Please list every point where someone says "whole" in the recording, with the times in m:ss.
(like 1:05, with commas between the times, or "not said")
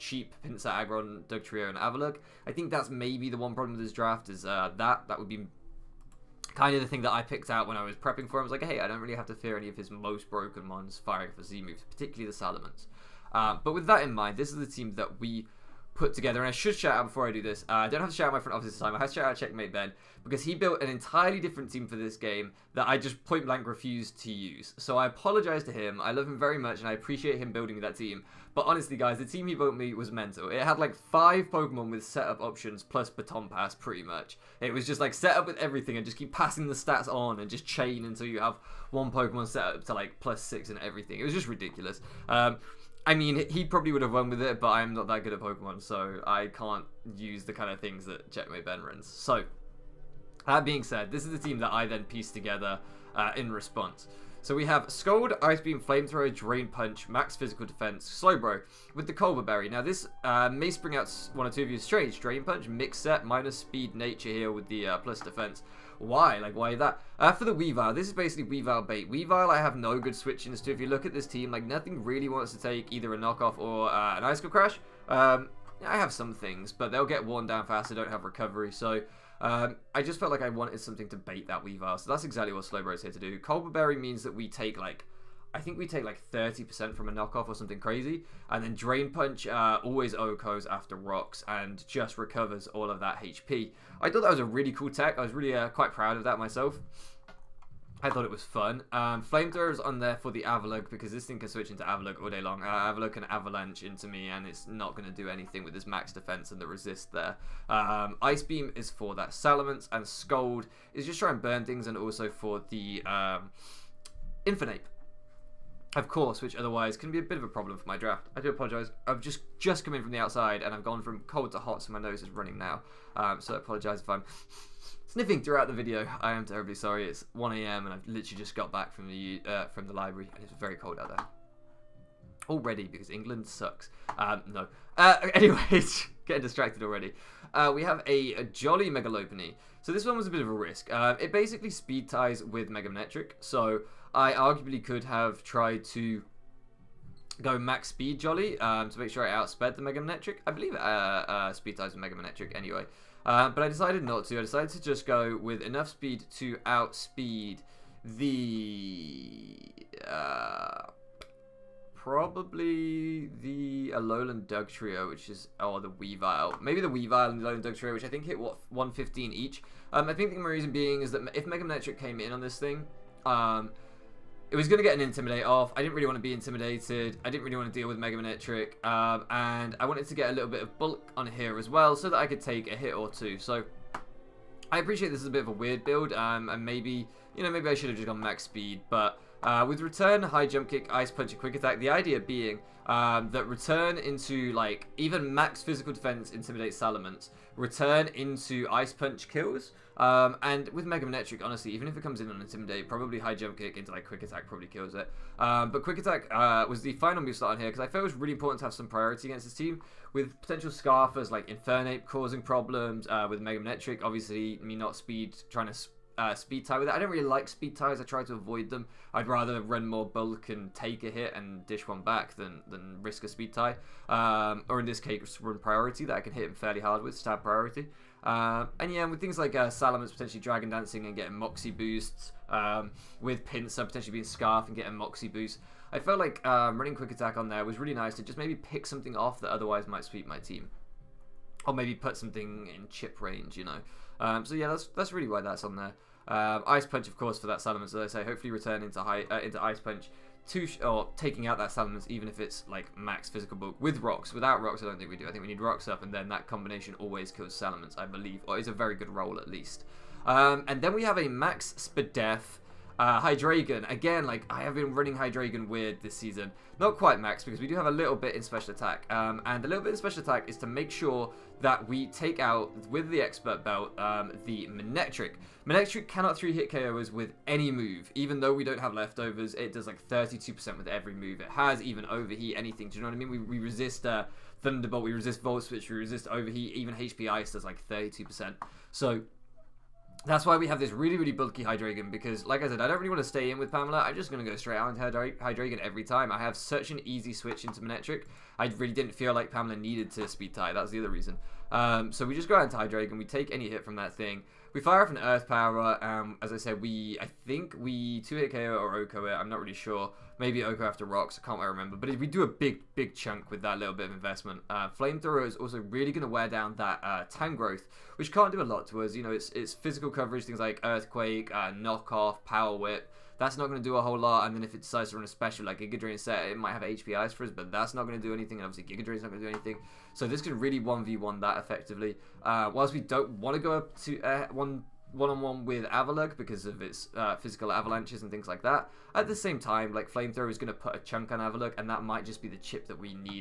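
5:24.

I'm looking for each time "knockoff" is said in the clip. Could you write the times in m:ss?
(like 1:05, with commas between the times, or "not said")
1:13, 1:27, 5:21.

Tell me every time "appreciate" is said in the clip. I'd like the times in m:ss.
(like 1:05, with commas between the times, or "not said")
0:26, 3:04.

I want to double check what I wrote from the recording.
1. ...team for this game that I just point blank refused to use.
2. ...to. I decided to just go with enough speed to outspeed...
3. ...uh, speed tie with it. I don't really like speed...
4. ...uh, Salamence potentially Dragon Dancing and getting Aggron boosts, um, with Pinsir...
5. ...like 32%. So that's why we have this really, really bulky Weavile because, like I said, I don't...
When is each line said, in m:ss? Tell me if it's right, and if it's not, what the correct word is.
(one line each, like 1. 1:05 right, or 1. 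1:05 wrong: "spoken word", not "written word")
1. 0:21 right
2. 2:34 right
3. 3:36 right
4. 3:49 wrong: "Moxie", not "Aggron"
5. 4:47 wrong: "Hydreigon", not "Weavile".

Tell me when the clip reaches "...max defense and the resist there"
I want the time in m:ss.
1:45.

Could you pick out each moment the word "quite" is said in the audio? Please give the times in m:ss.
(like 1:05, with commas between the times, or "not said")
1:35, 4:26.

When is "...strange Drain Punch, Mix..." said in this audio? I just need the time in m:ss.
1:01.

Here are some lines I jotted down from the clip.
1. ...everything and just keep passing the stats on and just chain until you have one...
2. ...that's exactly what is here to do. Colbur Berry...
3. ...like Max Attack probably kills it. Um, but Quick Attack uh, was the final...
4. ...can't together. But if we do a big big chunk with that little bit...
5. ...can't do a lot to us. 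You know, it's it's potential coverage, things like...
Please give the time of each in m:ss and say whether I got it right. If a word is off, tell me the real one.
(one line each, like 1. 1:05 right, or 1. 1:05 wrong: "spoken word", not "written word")
1. 0:35 right
2. 1:22 right
3. 3:23 wrong: "Quick", not "Max"
4. 5:11 wrong: "remember", not "together"
5. 5:18 wrong: "physical", not "potential".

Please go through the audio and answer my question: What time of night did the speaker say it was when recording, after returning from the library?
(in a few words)
1 a.m.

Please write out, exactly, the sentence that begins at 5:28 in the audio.
And obviously, Giga Drain's not going to do anything.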